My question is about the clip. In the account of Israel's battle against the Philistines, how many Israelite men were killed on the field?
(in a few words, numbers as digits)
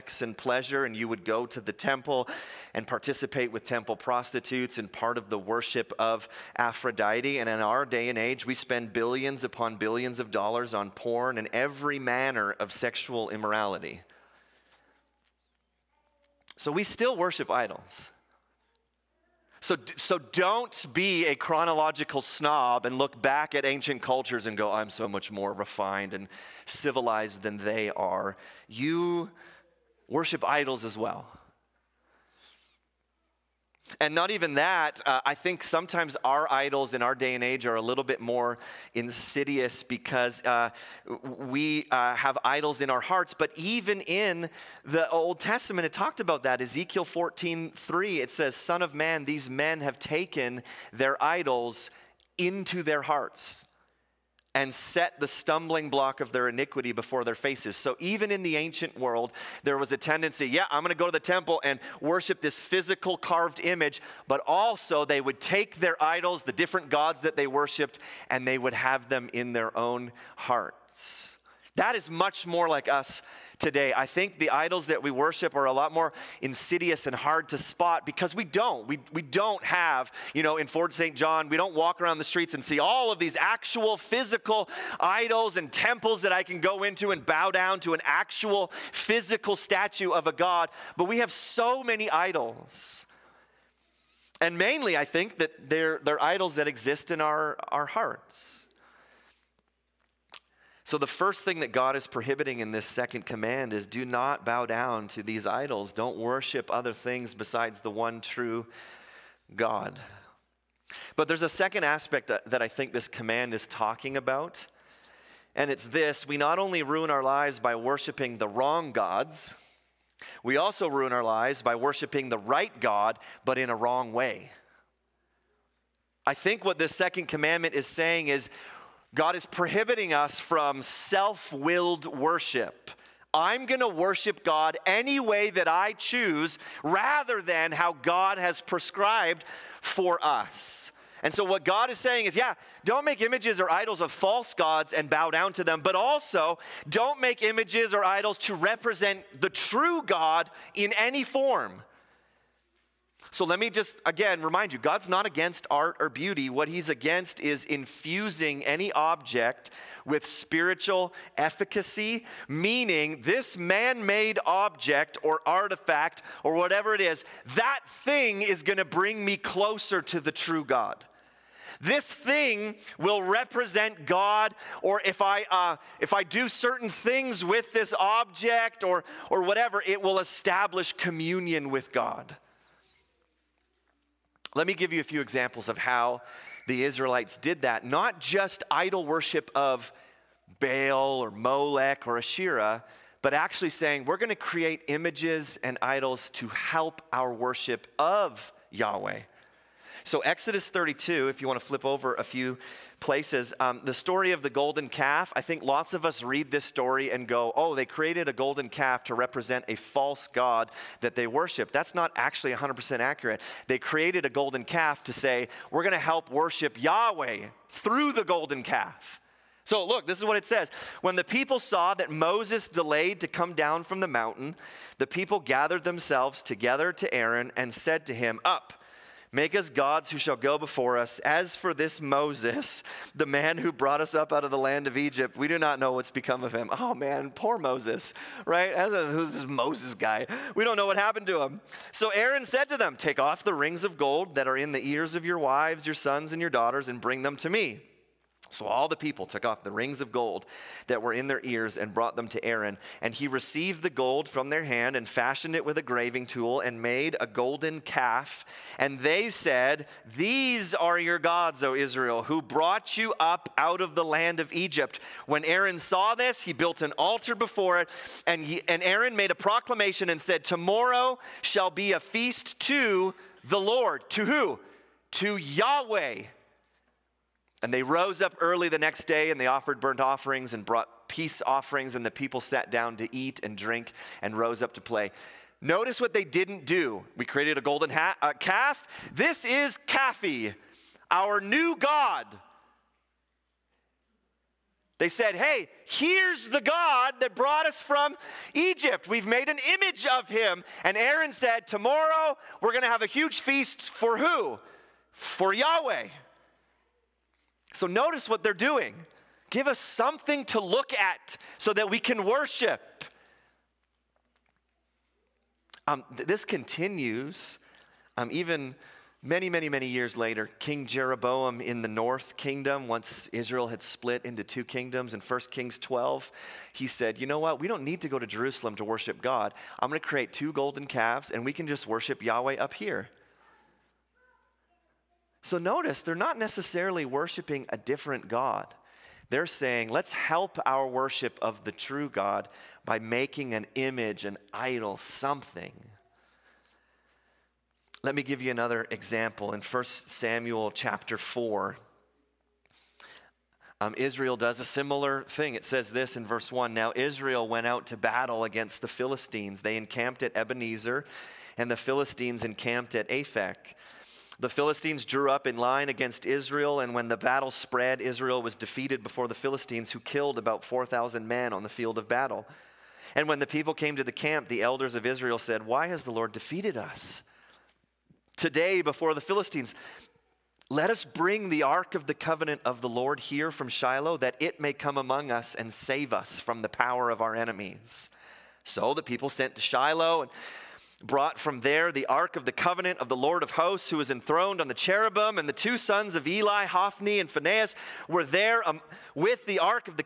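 4,000.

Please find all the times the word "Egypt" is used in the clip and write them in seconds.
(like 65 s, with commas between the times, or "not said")
234 s, 264 s, 298 s.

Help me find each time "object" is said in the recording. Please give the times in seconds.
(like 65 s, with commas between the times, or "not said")
158 s, 164 s, 177 s.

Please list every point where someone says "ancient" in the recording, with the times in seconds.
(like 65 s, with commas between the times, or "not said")
23 s, 58 s.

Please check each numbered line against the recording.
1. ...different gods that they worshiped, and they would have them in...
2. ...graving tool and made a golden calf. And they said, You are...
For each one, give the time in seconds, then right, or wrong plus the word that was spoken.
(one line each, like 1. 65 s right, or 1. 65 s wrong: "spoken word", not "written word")
1. 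66 s right
2. 255 s wrong: "These", not "You".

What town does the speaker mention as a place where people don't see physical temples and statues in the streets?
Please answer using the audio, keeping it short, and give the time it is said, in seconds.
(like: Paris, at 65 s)
Fort St. John, at 80 s.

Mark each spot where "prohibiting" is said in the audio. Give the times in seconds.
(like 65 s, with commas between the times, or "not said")
102 s, 129 s.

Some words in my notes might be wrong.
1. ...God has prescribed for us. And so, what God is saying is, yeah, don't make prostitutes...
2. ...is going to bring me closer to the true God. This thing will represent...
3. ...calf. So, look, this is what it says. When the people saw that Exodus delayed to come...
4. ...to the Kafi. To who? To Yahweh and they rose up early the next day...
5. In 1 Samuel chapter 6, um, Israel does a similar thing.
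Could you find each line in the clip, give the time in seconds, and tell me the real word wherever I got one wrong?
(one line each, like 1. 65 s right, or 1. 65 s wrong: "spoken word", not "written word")
1. 138 s wrong: "images", not "prostitutes"
2. 168 s right
3. 218 s wrong: "Moses", not "Exodus"
4. 272 s wrong: "Lord", not "Kafi"
5. 349 s wrong: "4", not "6".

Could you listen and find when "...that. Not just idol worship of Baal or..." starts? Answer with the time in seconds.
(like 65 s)
187 s.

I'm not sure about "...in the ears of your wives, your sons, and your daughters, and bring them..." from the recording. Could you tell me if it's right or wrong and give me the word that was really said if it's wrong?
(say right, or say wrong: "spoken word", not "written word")
right.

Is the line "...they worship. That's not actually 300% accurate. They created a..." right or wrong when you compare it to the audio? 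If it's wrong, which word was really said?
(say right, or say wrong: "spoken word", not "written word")
wrong: "100", not "300".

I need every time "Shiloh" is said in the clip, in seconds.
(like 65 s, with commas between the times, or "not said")
383 s, 389 s.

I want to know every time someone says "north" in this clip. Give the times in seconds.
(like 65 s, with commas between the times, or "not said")
321 s.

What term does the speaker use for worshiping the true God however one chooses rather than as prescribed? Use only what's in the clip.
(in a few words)
self willed worship.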